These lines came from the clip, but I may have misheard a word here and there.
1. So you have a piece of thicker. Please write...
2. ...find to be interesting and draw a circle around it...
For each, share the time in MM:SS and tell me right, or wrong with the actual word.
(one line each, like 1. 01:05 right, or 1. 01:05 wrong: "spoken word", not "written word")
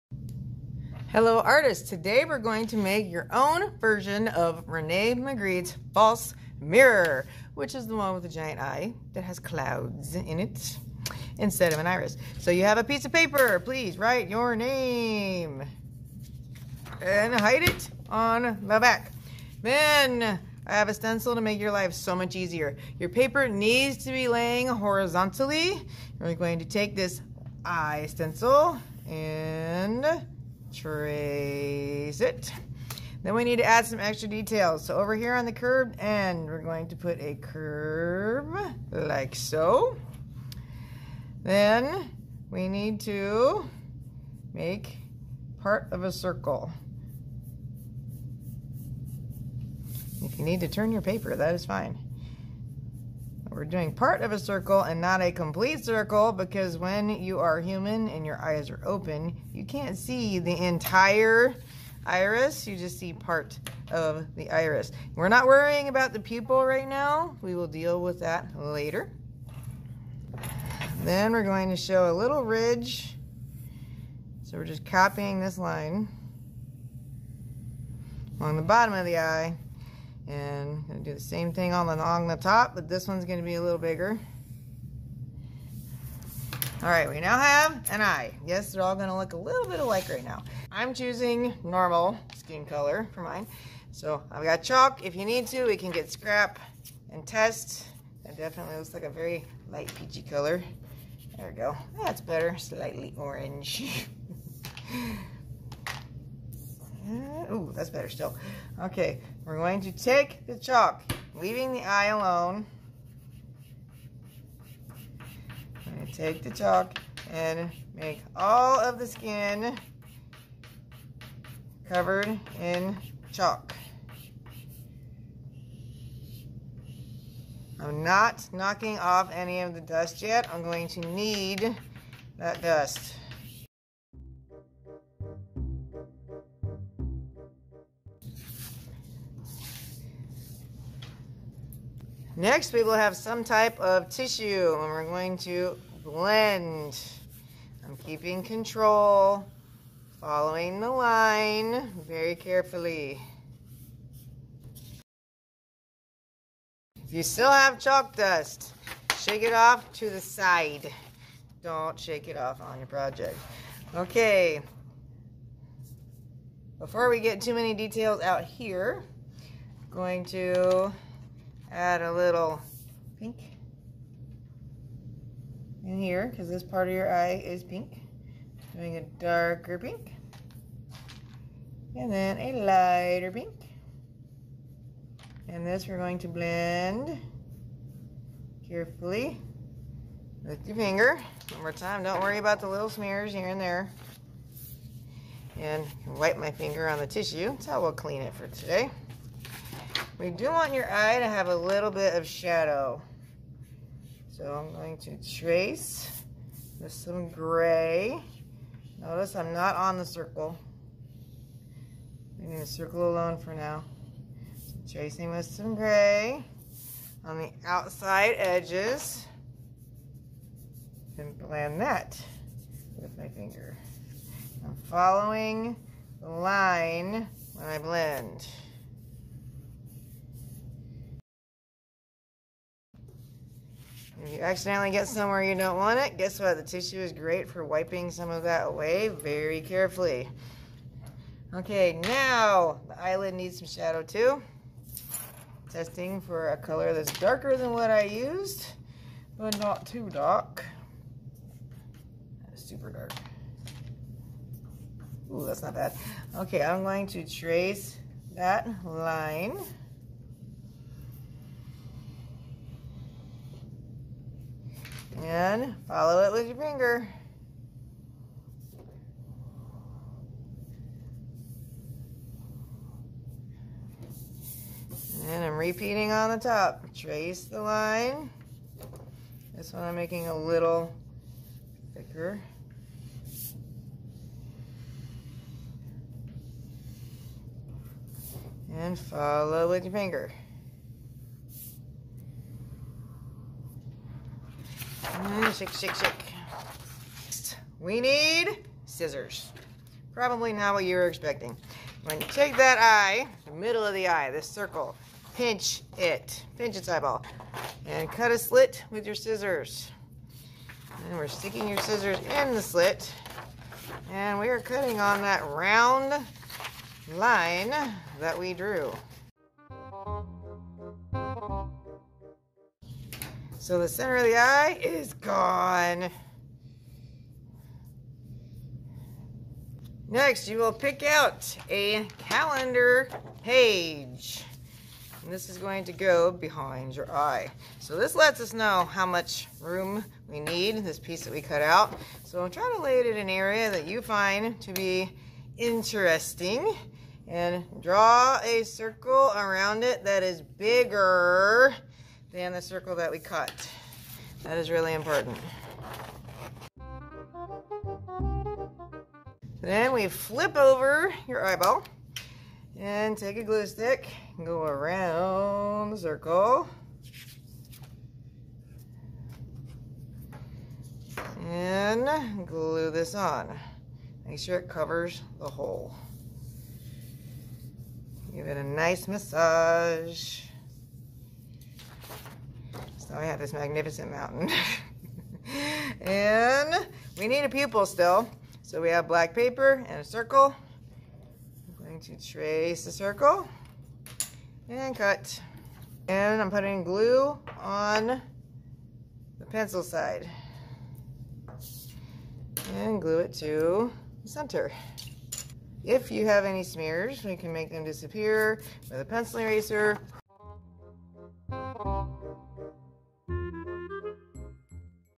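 1. 00:12 wrong: "paper", not "thicker"
2. 05:44 right.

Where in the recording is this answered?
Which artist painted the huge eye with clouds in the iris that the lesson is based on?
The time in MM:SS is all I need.
00:04.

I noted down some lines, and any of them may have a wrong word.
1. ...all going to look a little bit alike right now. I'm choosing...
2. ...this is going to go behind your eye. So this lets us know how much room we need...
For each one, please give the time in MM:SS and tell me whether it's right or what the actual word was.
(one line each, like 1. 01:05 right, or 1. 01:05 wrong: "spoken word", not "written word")
1. 01:28 right
2. 05:35 right.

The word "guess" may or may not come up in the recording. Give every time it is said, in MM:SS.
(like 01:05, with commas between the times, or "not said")
03:56.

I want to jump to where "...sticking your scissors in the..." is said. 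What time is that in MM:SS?
05:11.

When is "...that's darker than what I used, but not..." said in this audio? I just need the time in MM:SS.
04:06.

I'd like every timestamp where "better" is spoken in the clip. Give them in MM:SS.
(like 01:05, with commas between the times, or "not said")
01:42, 01:47.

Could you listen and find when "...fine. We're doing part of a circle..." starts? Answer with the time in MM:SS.
00:51.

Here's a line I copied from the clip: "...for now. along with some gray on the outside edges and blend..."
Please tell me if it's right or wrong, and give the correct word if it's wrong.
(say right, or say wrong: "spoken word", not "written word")
wrong: "tracing", not "along".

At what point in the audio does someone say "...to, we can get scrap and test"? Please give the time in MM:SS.
01:35.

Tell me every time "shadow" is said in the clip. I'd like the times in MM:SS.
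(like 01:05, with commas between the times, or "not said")
03:22, 04:03.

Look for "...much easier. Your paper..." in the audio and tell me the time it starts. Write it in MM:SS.
00:22.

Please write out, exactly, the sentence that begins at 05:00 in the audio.
Probably not what you were expecting.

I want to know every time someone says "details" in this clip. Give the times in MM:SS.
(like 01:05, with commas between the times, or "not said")
00:34, 02:47.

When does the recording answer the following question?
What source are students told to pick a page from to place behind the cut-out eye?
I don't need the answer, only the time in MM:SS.
05:32.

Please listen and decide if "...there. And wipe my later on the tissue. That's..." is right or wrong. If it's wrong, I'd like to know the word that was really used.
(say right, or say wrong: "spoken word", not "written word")
wrong: "finger", not "later".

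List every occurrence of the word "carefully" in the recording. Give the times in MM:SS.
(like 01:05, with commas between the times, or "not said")
02:32, 03:08, 03:59.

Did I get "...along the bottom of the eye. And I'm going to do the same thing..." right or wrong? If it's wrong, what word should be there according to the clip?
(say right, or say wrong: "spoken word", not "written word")
right.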